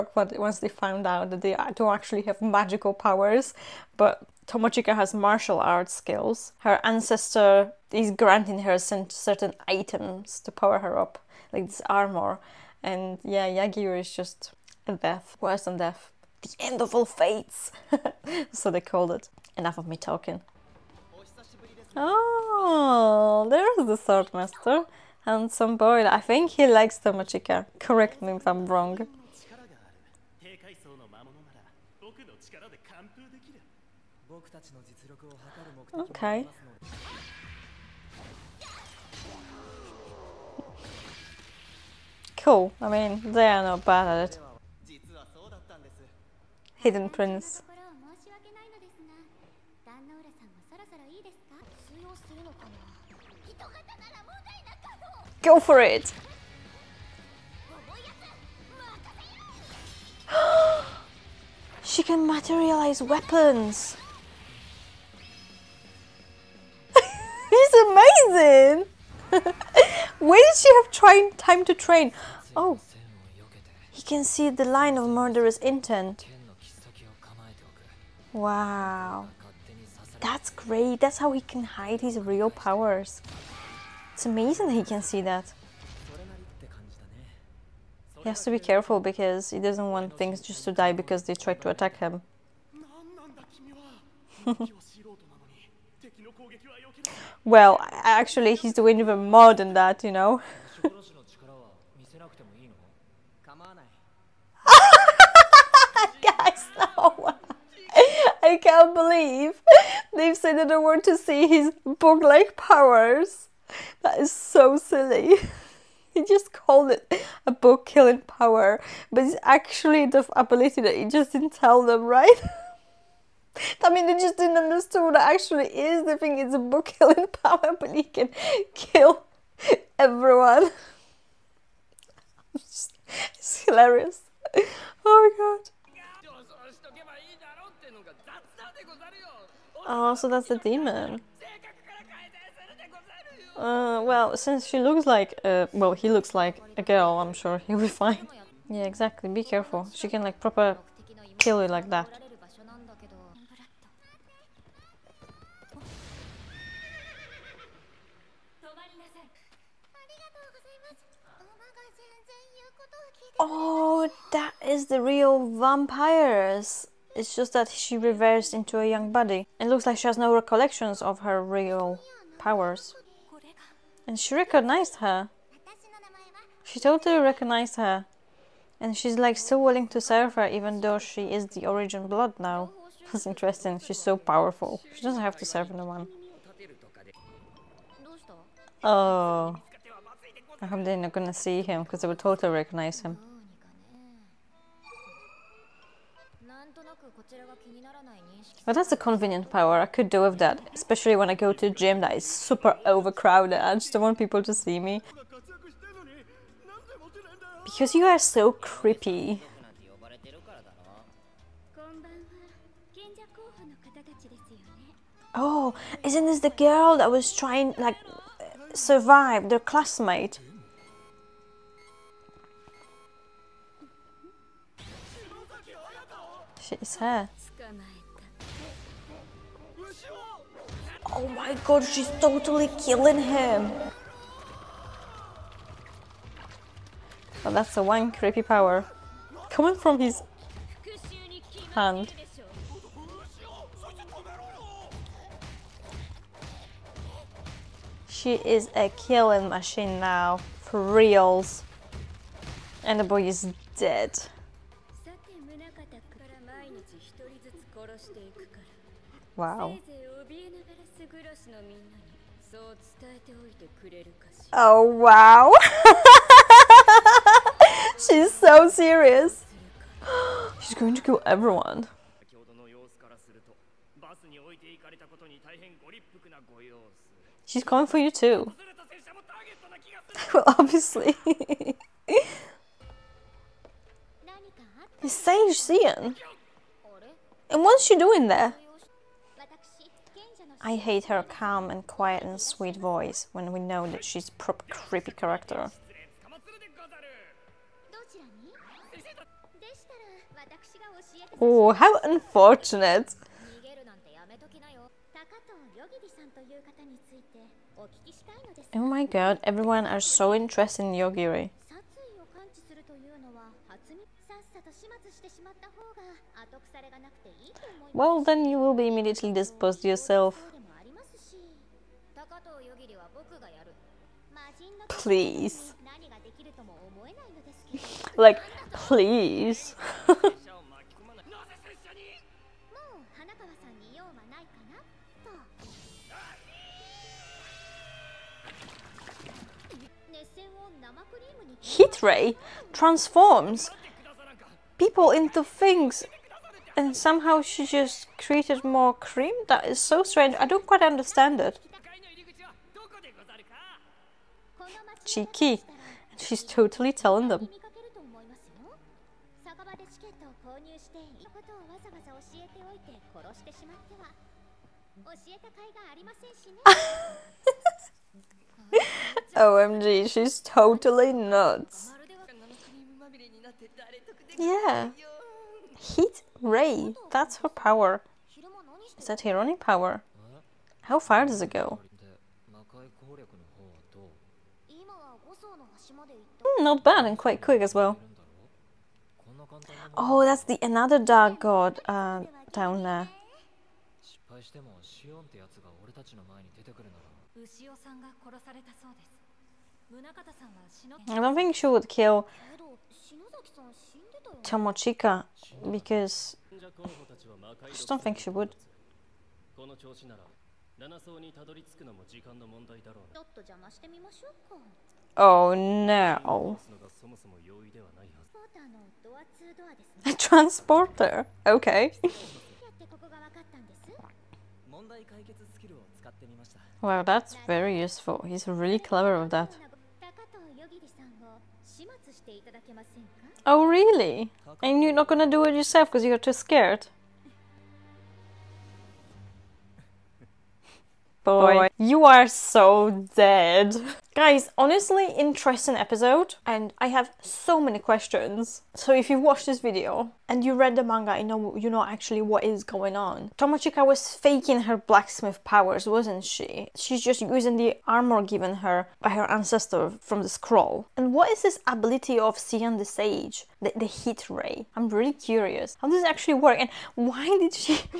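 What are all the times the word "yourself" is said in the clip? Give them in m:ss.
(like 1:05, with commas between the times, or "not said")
5:19, 7:15.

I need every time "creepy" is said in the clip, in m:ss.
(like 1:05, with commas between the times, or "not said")
3:28, 3:58, 4:54.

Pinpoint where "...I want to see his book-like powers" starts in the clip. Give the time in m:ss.
1:50.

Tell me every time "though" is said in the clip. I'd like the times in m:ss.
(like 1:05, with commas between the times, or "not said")
3:00.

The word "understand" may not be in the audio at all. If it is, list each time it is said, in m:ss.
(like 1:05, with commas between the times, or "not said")
2:04, 5:50.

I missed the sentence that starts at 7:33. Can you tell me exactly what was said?
Tomochika was faking her blacksmith powers, wasn't she?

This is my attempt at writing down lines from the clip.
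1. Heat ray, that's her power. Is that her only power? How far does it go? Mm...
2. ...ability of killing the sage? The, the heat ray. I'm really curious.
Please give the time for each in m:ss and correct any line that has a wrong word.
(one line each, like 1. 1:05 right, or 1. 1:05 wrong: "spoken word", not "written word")
1. 6:15 right
2. 7:41 wrong: "seeing", not "killing".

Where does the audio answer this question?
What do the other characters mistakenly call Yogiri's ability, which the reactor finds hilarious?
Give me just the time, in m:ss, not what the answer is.
1:57.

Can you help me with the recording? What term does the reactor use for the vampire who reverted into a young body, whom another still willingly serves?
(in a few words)
Origin blood.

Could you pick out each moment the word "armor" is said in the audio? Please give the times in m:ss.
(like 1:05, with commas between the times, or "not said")
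0:11, 7:37.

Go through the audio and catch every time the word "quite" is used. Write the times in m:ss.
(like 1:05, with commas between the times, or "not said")
5:50, 6:27.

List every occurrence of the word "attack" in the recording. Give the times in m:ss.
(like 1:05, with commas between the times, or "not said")
1:31.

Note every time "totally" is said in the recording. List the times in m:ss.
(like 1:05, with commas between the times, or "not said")
2:56, 3:12, 3:52, 5:56, 6:10.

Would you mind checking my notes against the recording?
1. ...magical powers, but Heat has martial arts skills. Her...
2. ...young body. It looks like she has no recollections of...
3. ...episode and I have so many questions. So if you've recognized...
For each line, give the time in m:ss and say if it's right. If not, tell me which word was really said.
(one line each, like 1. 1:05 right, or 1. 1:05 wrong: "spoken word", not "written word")
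1. 0:02 wrong: "Tomochika", not "Heat"
2. 2:48 right
3. 7:25 wrong: "watched", not "recognized".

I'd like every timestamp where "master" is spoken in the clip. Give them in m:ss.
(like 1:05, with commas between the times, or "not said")
0:24.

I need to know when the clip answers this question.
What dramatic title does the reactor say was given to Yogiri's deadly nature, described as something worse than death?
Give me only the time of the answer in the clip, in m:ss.
0:16.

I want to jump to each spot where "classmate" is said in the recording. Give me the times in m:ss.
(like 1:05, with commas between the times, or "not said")
3:39.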